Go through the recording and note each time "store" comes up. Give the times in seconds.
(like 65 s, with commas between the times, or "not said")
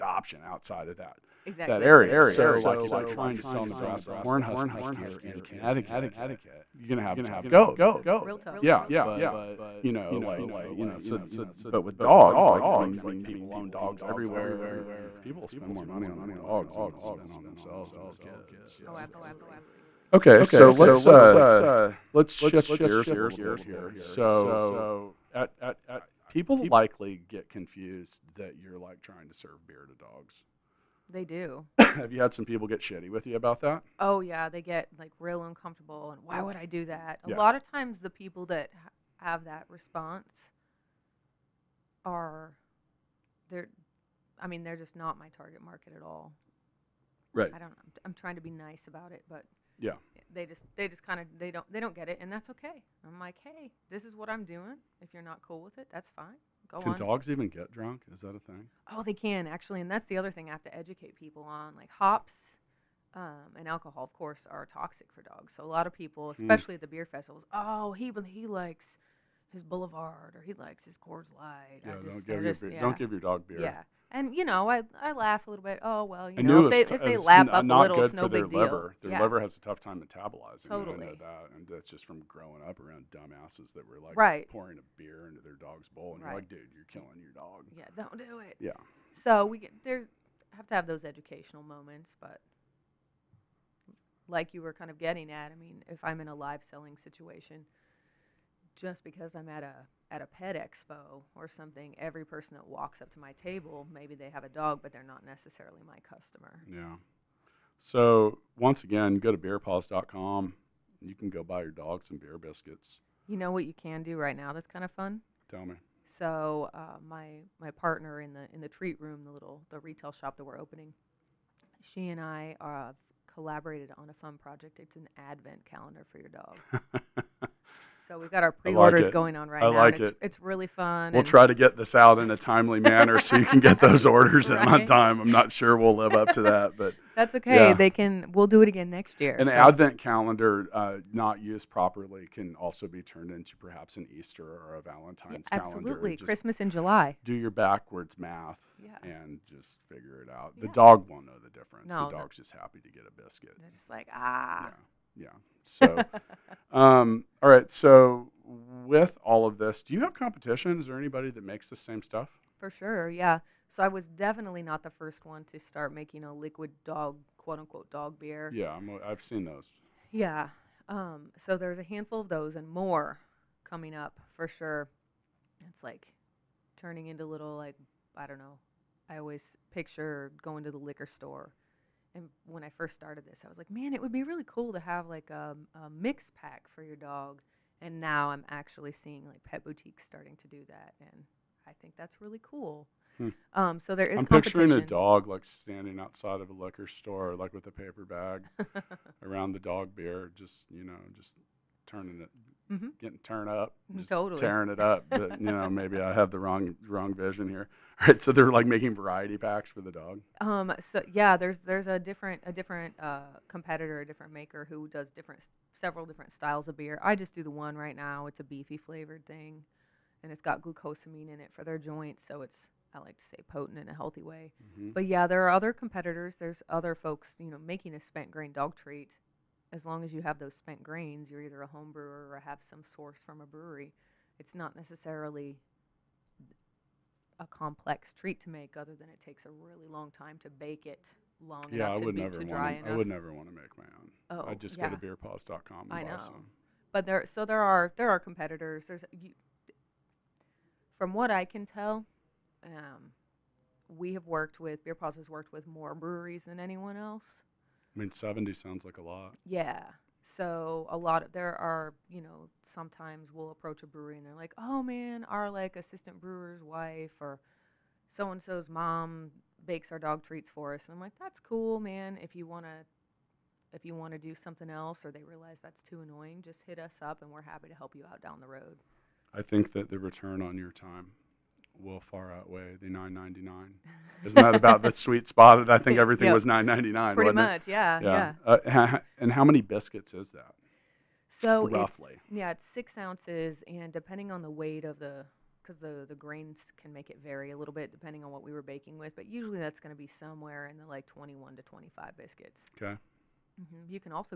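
181 s, 196 s.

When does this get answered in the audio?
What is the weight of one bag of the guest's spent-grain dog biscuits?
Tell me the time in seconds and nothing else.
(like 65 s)
292 s.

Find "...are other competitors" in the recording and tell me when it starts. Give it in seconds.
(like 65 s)
225 s.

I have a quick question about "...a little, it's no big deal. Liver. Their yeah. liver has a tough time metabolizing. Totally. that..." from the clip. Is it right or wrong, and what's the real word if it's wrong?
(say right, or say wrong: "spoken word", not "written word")
right.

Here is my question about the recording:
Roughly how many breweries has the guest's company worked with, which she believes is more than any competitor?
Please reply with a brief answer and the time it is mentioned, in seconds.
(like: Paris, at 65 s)
70, at 258 s.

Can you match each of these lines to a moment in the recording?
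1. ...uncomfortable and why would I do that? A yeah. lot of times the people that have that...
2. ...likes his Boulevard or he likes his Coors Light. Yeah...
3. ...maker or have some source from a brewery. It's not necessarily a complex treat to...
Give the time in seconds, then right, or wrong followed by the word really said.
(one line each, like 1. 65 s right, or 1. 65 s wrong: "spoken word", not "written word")
1. 35 s right
2. 68 s right
3. 231 s wrong: "brewer", not "maker".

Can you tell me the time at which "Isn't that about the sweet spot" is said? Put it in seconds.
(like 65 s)
284 s.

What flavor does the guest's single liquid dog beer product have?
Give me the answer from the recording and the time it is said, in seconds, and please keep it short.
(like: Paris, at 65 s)
Beefy, at 218 s.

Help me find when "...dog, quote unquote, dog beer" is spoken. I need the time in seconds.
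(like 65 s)
166 s.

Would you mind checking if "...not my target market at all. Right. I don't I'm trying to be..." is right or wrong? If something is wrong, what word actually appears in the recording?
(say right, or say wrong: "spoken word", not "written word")
right.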